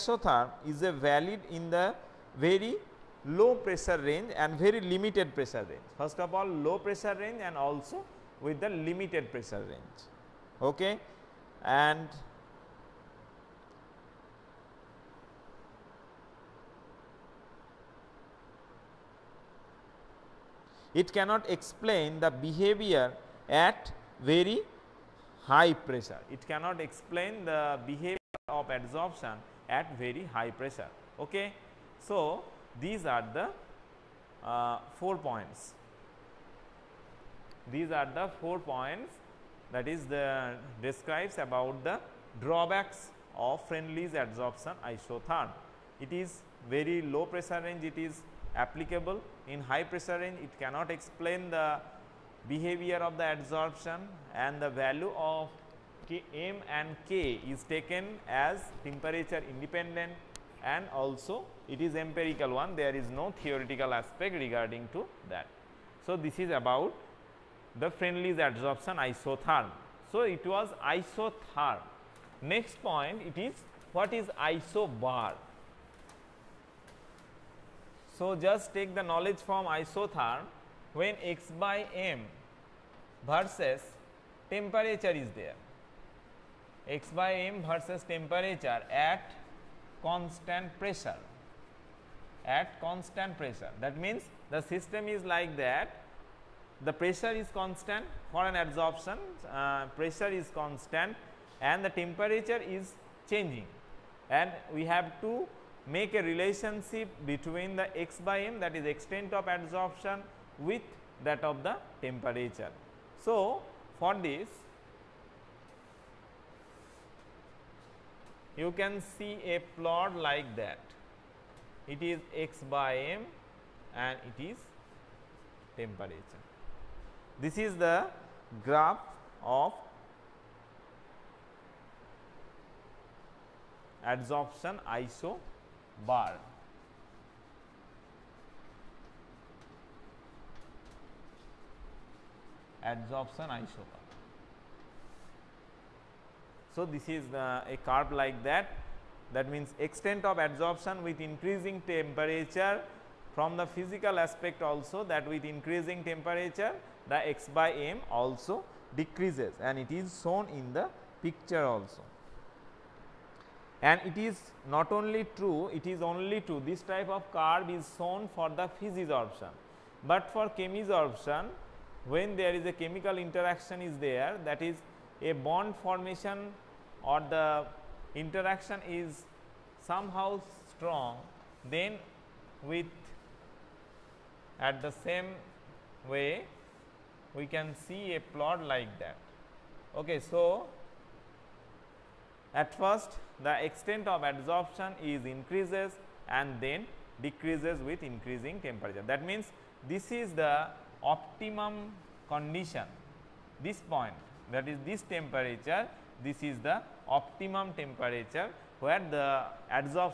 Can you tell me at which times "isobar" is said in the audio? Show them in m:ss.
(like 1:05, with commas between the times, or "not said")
1:14, 2:14.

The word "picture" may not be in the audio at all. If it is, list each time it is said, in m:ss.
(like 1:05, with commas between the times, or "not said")
2:41.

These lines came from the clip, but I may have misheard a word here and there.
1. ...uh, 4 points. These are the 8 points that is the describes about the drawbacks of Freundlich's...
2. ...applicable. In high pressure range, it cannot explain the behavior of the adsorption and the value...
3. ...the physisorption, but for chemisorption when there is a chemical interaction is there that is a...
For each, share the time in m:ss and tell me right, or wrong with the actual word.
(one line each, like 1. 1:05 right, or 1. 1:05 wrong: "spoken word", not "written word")
1. 0:34 wrong: "4", not "8"
2. 0:48 right
3. 2:48 right.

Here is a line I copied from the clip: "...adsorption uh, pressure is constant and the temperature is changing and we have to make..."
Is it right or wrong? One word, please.
right.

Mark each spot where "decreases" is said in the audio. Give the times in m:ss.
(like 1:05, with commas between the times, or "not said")
2:39, 3:17.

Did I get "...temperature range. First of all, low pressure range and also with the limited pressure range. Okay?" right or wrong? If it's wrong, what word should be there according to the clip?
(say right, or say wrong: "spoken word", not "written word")
wrong: "pressure", not "temperature".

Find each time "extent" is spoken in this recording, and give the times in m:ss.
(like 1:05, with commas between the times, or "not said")
1:48, 2:29, 3:13.